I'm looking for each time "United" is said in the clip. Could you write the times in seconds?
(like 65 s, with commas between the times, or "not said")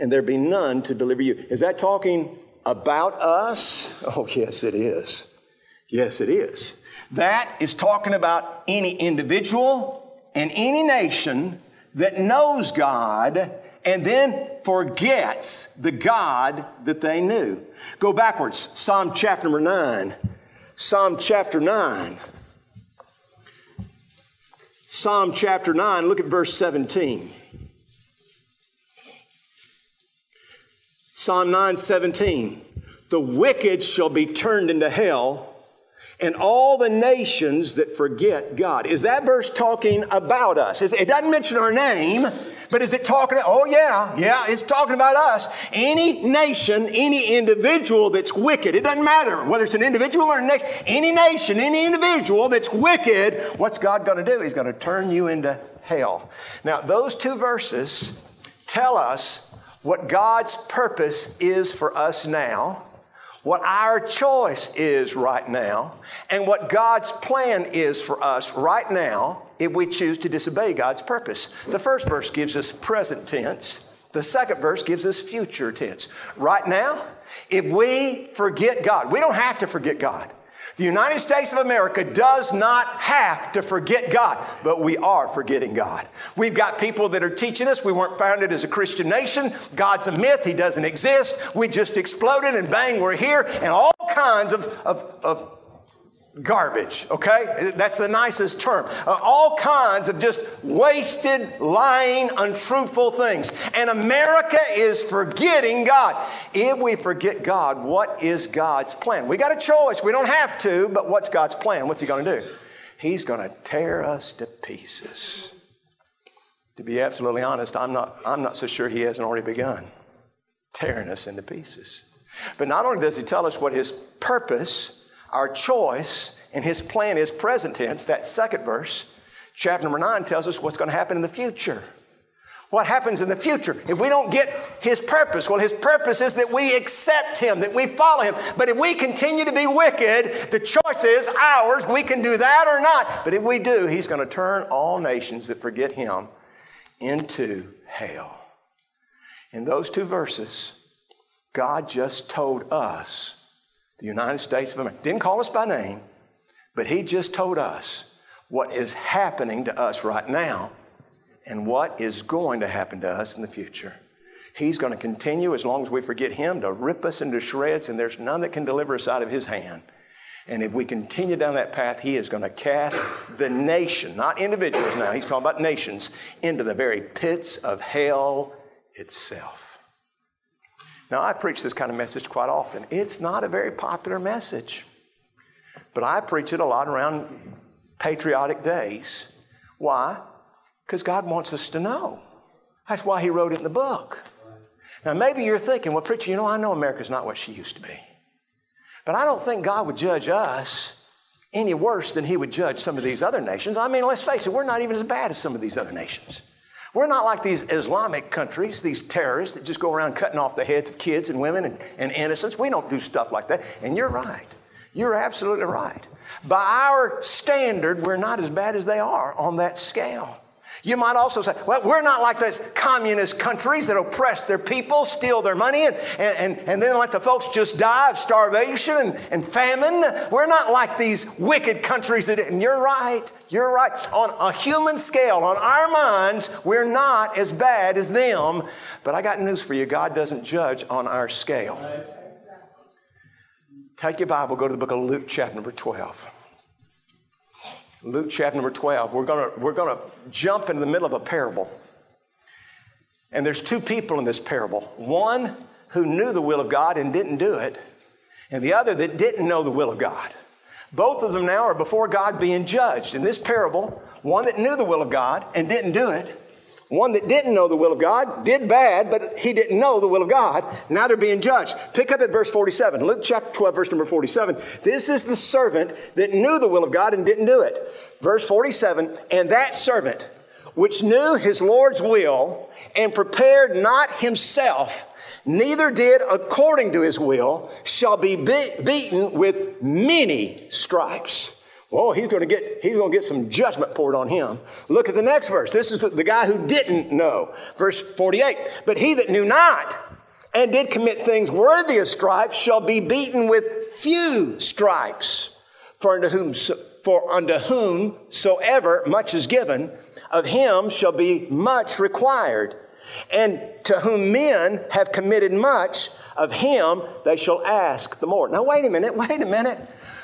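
80 s, 154 s.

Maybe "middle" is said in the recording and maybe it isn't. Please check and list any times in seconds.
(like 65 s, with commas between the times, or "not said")
250 s.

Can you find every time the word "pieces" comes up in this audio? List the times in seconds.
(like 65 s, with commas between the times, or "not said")
114 s, 121 s.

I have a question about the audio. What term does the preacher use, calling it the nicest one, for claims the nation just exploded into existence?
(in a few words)
garbage.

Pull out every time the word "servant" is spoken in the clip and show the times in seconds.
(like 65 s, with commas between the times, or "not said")
275 s, 279 s.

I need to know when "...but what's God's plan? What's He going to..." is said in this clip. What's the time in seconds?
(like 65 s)
110 s.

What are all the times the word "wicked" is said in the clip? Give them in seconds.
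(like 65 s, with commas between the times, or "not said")
33 s, 48 s, 52 s, 139 s, 231 s.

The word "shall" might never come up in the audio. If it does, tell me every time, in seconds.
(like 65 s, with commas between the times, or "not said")
33 s, 287 s, 302 s, 310 s, 317 s.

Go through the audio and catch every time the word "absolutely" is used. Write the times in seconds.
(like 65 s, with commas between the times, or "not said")
117 s, 215 s.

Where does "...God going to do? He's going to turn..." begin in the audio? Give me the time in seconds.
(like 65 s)
53 s.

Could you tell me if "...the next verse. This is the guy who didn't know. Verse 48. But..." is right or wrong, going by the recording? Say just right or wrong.
right.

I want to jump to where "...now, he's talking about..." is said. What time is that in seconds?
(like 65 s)
174 s.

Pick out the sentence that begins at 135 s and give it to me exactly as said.
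Well, his purpose is that we accept him, that we follow him.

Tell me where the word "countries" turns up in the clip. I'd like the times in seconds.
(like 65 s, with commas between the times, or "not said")
208 s, 223 s, 231 s.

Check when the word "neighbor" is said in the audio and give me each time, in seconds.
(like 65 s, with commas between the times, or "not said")
not said.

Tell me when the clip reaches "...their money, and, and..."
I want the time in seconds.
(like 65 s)
225 s.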